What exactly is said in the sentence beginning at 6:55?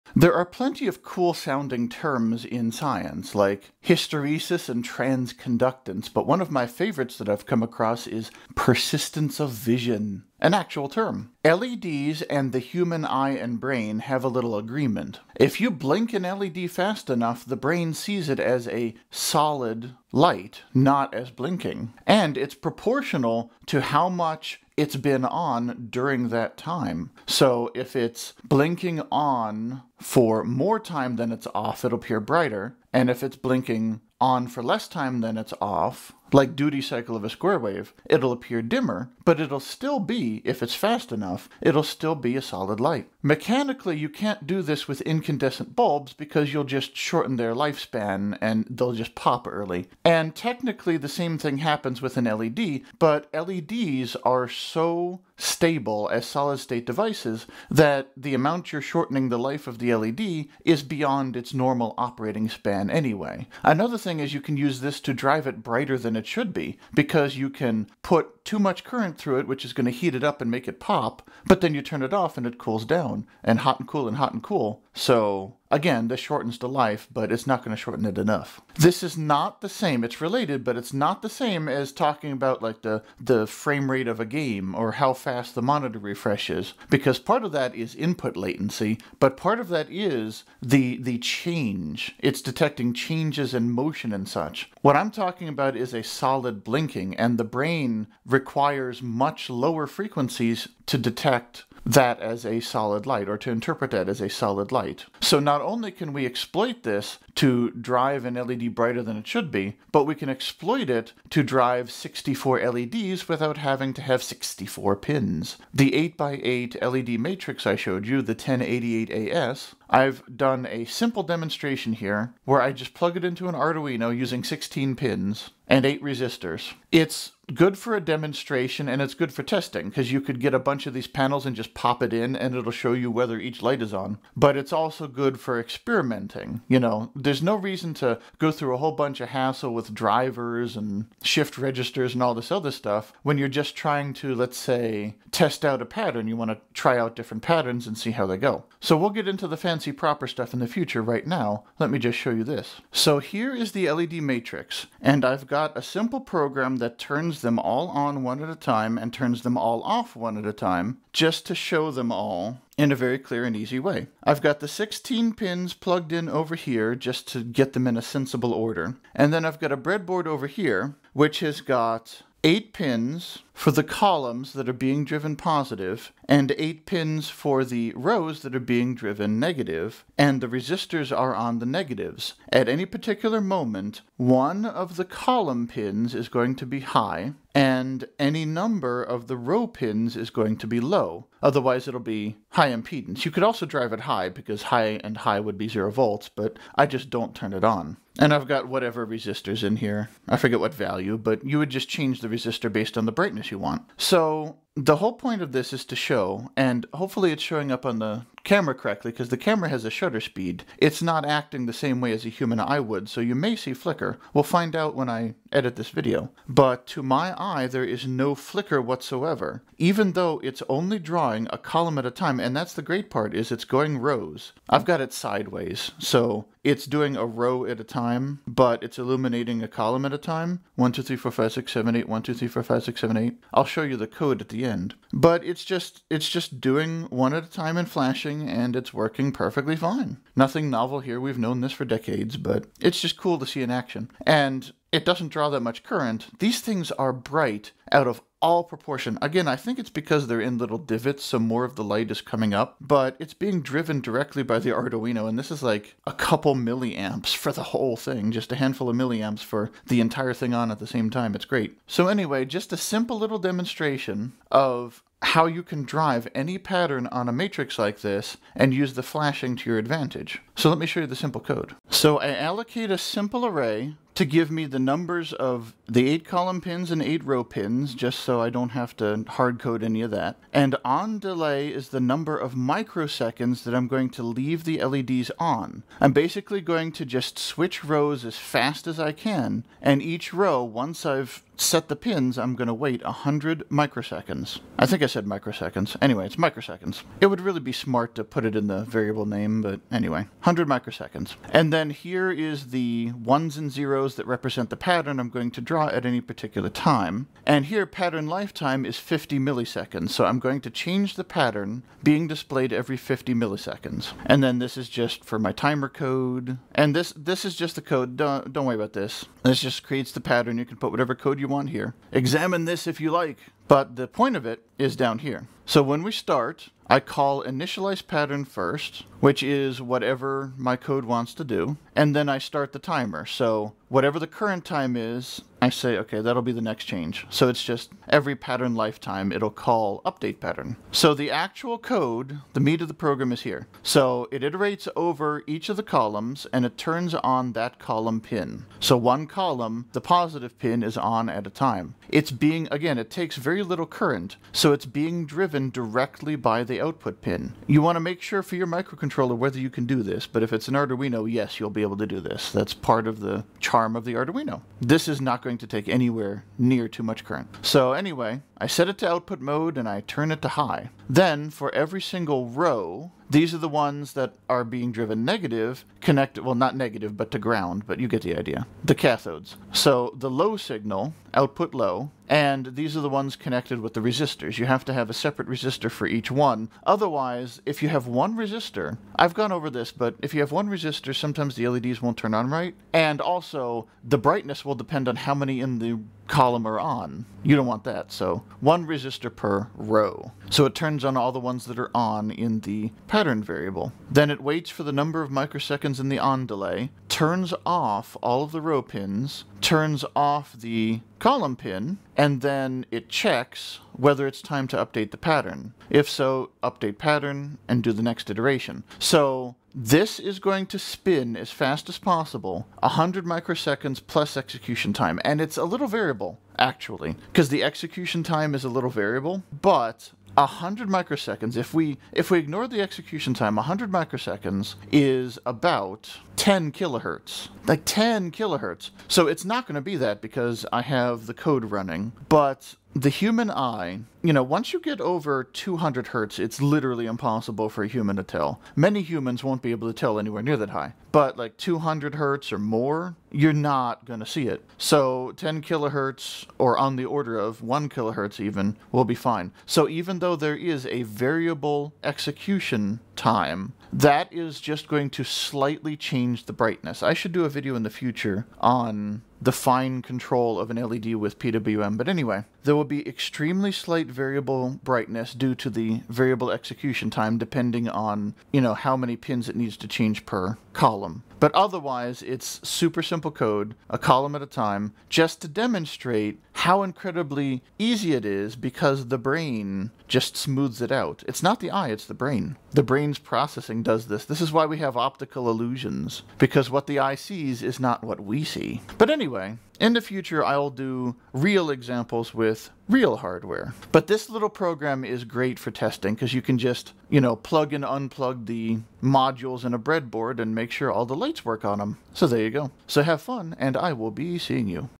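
If so, update pattern and do the next iteration.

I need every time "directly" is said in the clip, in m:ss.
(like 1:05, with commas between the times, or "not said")
4:14, 5:55.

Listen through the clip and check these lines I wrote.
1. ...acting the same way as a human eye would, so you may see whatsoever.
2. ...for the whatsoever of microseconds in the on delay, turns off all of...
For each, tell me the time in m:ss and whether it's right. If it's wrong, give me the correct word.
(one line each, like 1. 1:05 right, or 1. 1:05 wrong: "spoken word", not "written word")
1. 3:31 wrong: "flicker", not "whatsoever"
2. 6:44 wrong: "number", not "whatsoever".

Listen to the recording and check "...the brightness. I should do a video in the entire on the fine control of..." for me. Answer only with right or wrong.
wrong.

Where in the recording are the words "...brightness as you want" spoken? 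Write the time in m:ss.
3:23.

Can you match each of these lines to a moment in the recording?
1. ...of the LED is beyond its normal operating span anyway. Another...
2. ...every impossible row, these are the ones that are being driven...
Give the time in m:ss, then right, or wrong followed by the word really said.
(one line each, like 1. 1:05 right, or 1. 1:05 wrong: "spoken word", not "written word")
1. 0:59 right
2. 6:11 wrong: "single", not "impossible".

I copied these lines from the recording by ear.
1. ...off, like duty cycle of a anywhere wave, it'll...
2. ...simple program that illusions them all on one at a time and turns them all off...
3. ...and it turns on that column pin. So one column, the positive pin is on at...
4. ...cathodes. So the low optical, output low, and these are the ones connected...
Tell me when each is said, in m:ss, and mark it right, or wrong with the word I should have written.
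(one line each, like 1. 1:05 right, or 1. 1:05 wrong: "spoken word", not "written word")
1. 0:35 wrong: "square", not "anywhere"
2. 2:35 wrong: "turns", not "illusions"
3. 5:46 right
4. 6:18 wrong: "signal", not "optical".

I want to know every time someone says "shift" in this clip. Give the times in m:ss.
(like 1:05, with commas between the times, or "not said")
2:21.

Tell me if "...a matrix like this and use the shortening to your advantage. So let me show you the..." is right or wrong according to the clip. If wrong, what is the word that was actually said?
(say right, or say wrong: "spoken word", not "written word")
wrong: "flashing", not "shortening".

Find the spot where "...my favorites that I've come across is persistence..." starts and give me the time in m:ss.
0:06.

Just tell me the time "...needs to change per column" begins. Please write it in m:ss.
7:59.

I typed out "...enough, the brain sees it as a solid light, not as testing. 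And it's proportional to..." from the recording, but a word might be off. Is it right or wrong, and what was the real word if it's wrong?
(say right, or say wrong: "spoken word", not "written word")
wrong: "blinking", not "testing".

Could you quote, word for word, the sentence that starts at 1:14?
So, again, this shortens the life, but it's not going to shorten it enough.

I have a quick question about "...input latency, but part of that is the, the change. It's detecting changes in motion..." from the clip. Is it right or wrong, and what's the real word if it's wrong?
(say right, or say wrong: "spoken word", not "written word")
right.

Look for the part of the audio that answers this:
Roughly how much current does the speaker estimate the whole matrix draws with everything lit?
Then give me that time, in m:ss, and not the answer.
4:16.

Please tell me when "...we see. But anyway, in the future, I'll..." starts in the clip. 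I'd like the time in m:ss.
8:18.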